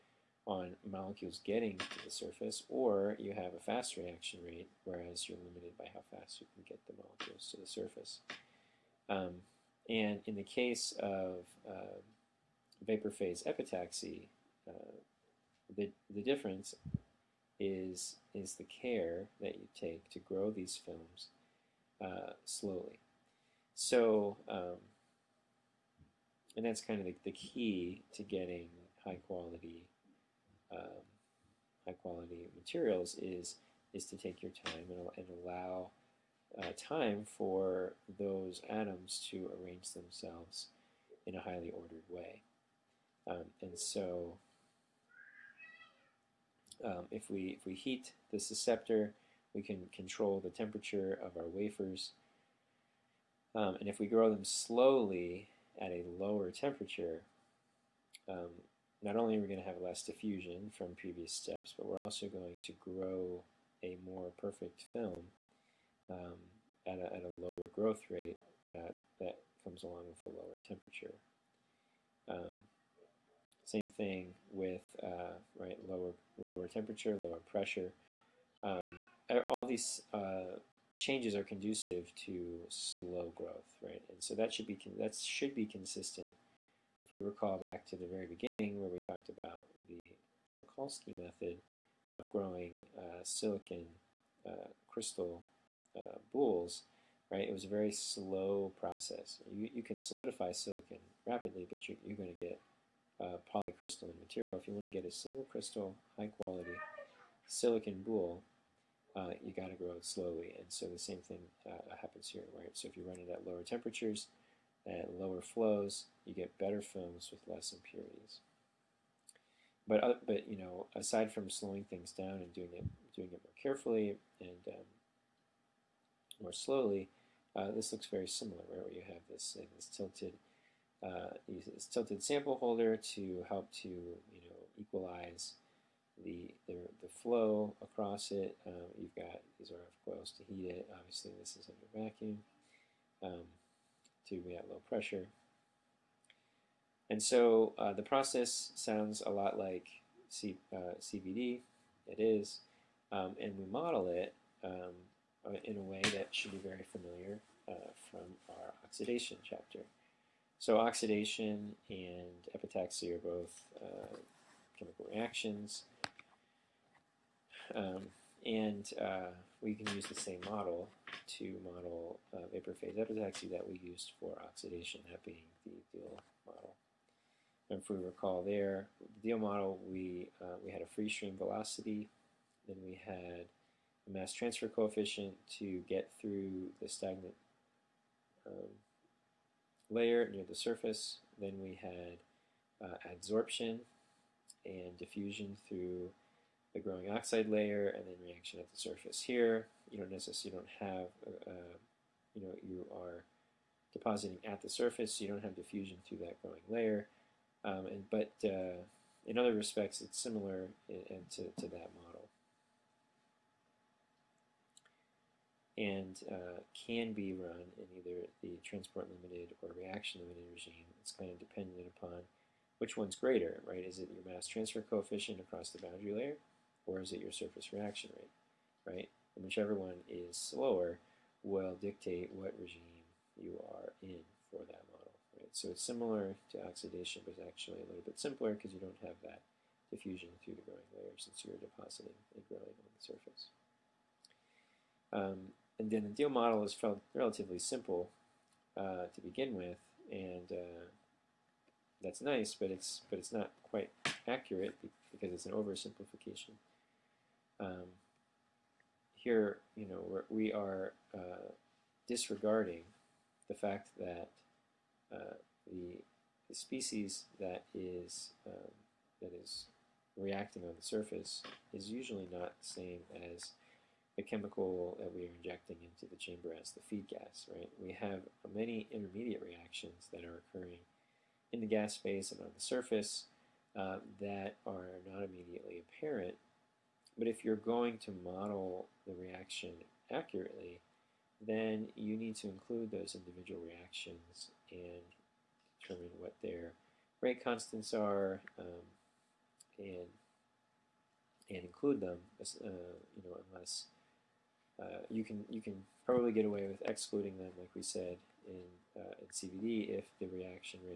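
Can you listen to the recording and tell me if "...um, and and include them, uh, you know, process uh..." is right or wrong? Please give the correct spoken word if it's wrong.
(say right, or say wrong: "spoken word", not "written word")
wrong: "unless", not "process".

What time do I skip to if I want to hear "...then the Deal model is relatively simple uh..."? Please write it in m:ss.
4:05.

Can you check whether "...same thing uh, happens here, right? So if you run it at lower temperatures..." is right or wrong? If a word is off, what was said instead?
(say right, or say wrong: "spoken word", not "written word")
right.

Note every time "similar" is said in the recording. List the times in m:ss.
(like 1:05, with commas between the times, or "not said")
2:08, 3:30, 3:55.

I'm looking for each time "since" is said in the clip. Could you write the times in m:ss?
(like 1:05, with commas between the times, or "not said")
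4:01.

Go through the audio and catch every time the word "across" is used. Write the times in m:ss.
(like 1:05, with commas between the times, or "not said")
2:17, 3:45.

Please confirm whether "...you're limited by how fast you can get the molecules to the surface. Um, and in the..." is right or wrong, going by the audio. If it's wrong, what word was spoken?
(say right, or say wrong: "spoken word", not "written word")
right.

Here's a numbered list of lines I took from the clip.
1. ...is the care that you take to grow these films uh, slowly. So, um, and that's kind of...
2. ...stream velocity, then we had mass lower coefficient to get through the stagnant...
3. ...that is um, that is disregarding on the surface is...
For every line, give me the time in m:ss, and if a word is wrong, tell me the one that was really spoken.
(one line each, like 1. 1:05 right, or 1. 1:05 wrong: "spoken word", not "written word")
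1. 0:18 right
2. 3:01 wrong: "transfer", not "lower"
3. 4:27 wrong: "reacting", not "disregarding".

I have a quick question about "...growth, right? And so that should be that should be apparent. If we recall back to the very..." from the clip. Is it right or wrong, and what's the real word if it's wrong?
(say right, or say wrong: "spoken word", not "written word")
wrong: "consistent", not "apparent".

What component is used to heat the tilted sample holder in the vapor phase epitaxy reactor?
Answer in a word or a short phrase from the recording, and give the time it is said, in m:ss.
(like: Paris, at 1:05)
RF coils, at 2:19.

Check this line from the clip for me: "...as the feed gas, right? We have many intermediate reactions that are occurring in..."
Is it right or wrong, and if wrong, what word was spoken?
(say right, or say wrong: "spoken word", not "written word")
right.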